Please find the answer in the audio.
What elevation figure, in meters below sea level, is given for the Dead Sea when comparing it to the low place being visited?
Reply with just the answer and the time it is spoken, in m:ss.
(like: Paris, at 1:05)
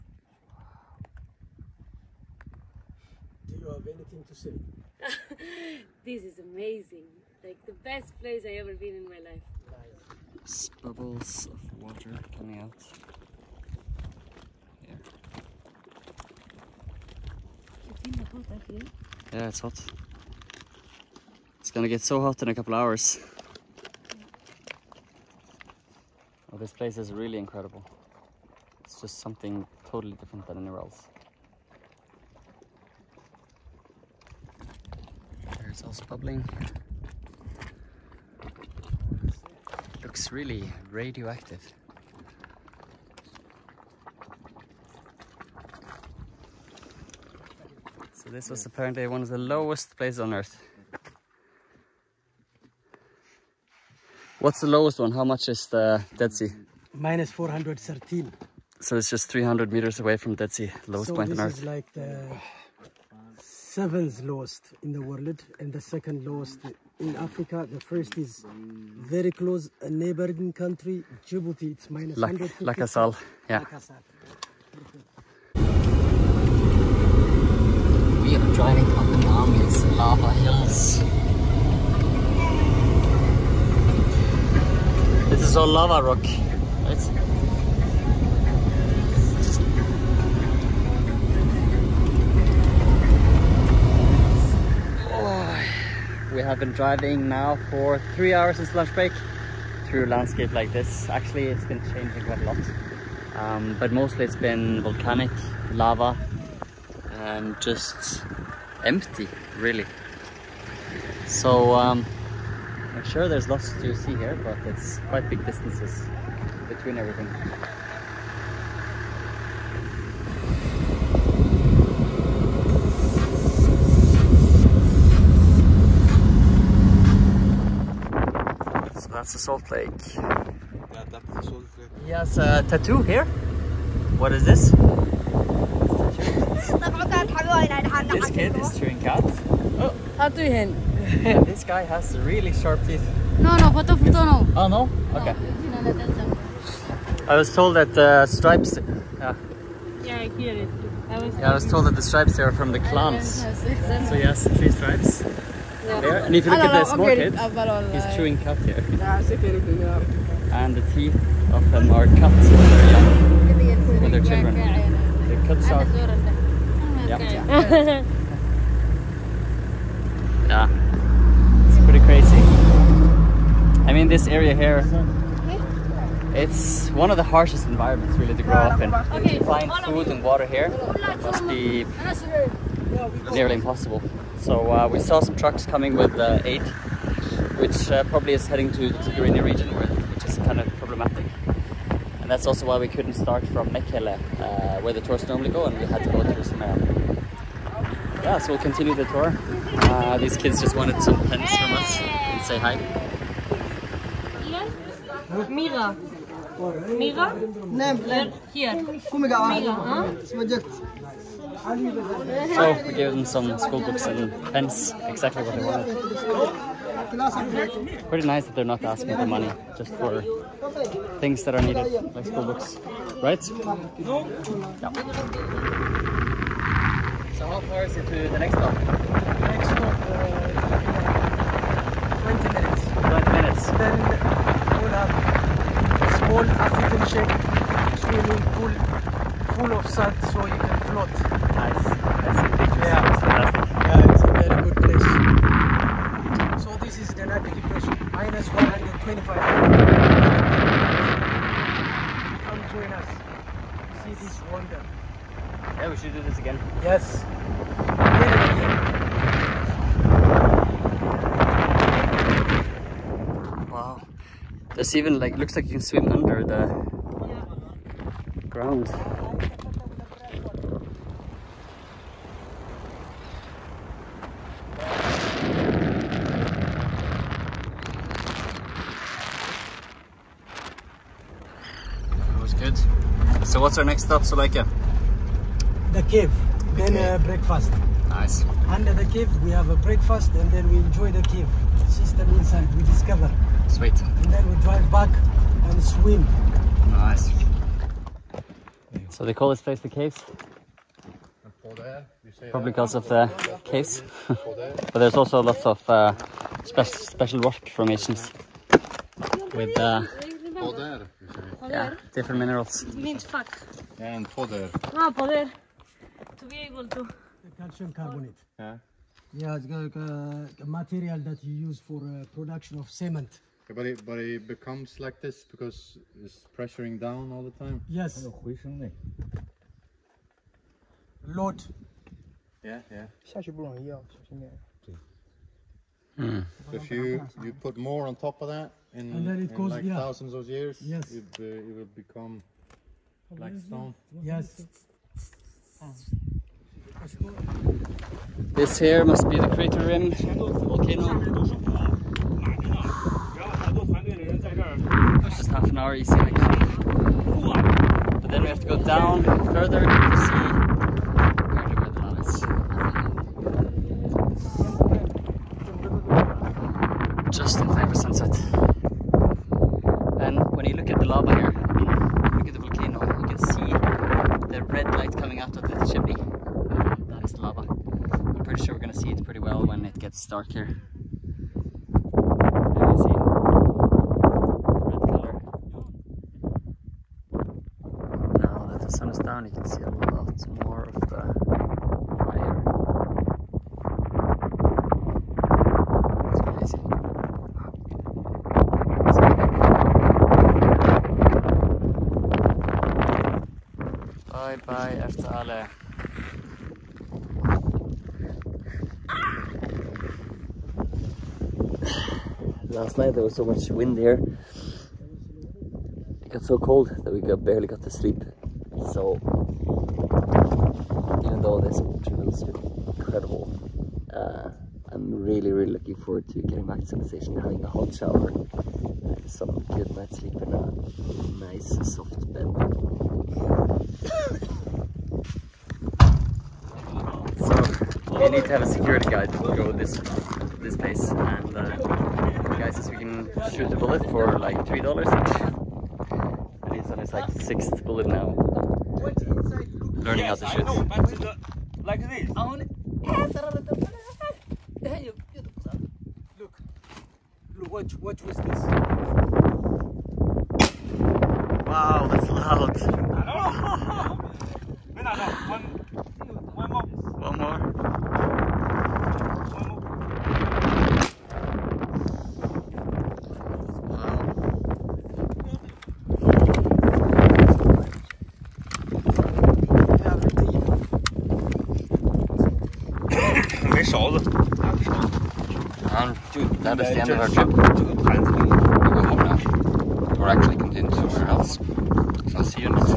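-413, at 0:56.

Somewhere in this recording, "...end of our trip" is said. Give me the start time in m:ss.
8:06.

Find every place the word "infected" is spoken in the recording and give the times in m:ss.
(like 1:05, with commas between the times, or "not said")
not said.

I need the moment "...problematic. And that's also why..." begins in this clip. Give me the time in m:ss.
3:10.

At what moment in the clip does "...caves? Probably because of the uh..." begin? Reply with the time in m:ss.
4:59.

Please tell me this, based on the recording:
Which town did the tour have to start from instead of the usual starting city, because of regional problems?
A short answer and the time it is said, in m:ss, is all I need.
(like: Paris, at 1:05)
Semera, at 3:16.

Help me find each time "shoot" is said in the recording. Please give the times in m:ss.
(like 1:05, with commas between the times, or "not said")
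7:23, 7:30.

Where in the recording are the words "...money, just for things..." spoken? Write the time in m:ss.
3:39.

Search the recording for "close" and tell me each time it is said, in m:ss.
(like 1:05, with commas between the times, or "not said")
1:09.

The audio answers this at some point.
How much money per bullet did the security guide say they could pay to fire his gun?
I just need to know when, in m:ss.
7:24.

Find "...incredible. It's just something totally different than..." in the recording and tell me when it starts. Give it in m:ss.
0:27.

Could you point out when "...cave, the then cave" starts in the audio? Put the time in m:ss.
4:46.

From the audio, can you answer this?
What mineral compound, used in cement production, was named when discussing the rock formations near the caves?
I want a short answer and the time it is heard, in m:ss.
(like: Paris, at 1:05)
Calcium carbonate, at 5:17.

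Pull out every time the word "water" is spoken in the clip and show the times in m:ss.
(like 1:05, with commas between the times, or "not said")
0:11, 3:00.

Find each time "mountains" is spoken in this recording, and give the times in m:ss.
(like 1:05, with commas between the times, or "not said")
1:19.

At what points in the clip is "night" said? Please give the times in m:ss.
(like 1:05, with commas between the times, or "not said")
6:52, 7:09.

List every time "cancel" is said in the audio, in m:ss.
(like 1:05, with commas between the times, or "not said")
not said.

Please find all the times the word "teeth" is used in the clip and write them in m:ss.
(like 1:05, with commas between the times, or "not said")
2:22, 2:40.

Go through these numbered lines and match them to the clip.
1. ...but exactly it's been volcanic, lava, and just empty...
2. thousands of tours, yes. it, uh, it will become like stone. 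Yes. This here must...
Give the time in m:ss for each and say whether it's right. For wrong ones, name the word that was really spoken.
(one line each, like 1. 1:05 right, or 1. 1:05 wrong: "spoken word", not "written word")
1. 1:43 wrong: "mostly", not "exactly"
2. 5:39 wrong: "years", not "tours".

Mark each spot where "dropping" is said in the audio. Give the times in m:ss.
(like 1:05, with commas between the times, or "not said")
not said.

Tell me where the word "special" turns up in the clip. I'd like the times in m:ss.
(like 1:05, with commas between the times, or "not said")
5:06.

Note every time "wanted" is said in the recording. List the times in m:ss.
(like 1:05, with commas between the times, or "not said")
3:20, 3:35.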